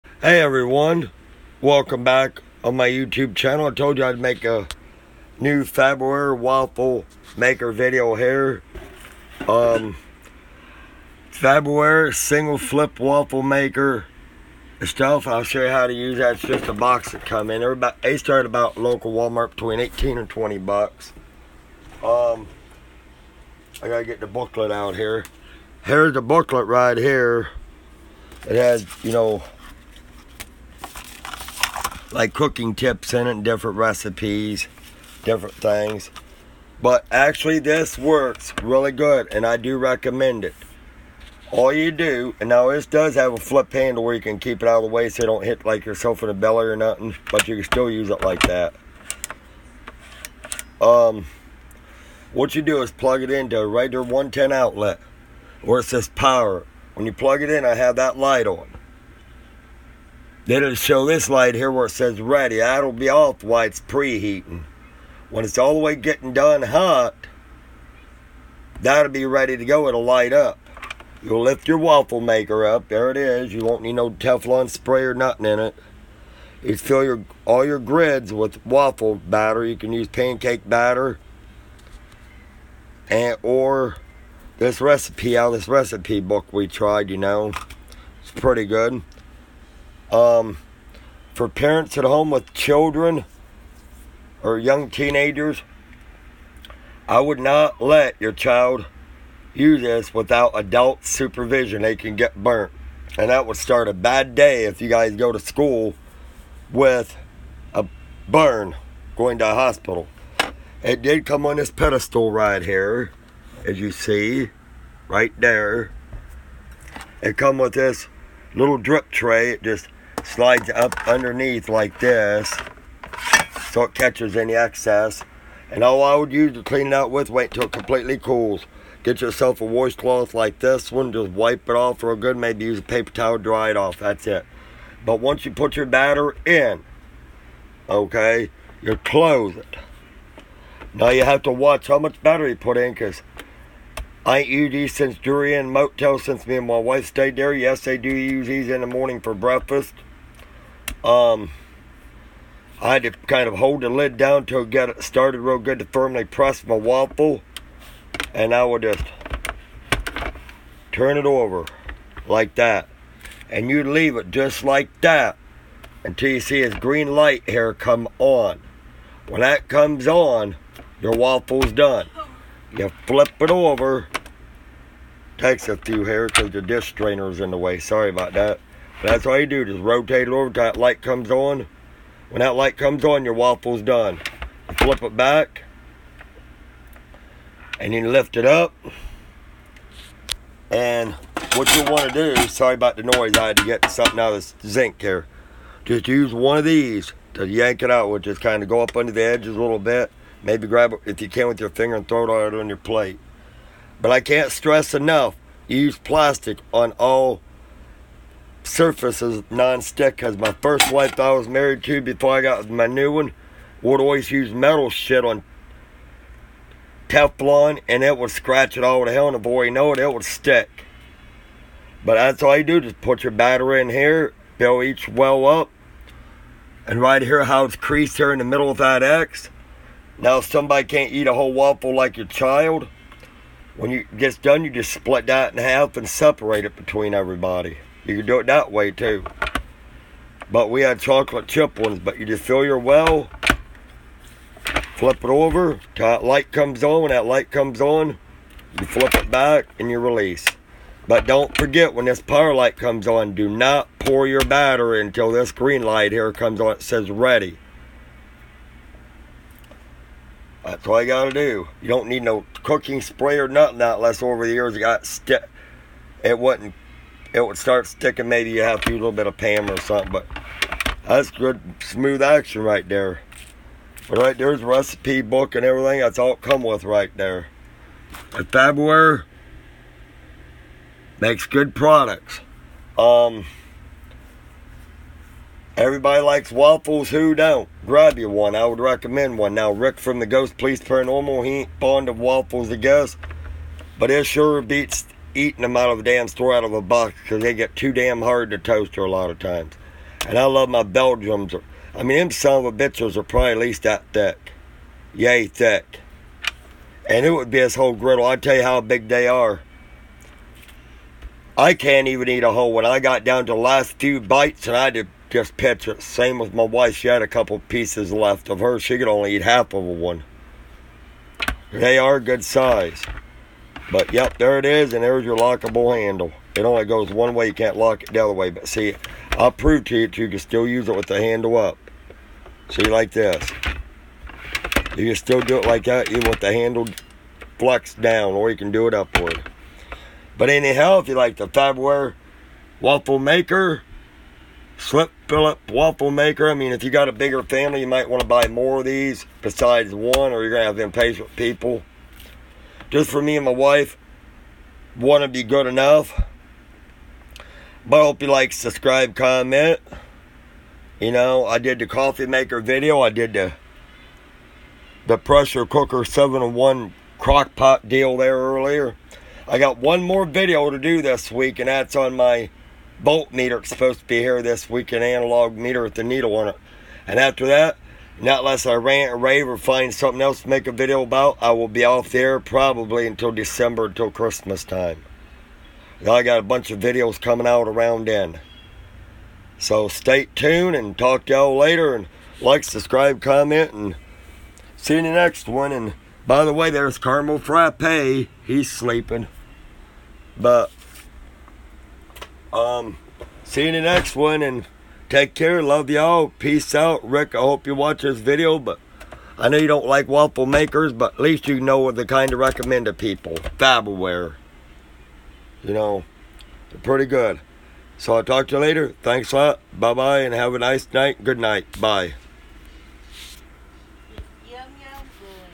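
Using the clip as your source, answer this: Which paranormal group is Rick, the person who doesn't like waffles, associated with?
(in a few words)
Ghost Police Paranormal.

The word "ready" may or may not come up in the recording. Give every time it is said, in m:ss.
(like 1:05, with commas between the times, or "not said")
1:02, 1:09, 4:17.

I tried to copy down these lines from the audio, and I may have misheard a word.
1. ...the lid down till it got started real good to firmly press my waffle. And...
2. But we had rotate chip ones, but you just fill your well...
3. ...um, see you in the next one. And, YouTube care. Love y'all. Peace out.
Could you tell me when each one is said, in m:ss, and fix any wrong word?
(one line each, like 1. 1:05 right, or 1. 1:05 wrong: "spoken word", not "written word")
1. 2:33 right
2. 4:00 wrong: "chocolate", not "rotate"
3. 6:42 wrong: "Take", not "YouTube".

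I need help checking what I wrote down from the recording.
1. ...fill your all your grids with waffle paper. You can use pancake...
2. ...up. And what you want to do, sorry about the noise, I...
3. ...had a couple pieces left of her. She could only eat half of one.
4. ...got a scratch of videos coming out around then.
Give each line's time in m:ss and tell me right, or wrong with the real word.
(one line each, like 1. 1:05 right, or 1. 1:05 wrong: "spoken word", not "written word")
1. 1:16 wrong: "batter", not "paper"
2. 3:08 right
3. 5:17 right
4. 6:26 wrong: "bunch", not "scratch".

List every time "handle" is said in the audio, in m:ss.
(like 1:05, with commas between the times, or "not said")
0:43, 5:25, 5:31, 5:36.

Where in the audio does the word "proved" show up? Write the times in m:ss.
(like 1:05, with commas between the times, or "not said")
5:29.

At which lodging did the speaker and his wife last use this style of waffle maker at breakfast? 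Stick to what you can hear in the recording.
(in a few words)
Durian Motel.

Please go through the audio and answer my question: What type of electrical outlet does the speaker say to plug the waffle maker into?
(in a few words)
110 outlet.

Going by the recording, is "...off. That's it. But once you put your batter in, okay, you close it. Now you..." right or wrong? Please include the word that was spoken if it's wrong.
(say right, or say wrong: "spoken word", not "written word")
right.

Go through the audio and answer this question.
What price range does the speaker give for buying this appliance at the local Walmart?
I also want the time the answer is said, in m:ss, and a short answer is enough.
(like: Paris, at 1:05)
$18 to $20, at 0:19.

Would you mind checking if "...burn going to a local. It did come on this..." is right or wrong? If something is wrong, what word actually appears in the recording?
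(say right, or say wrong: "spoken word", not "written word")
wrong: "hospital", not "local".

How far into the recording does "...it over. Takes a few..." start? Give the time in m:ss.
2:53.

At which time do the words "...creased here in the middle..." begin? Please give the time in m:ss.
3:47.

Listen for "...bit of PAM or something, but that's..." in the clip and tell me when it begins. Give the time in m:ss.
4:29.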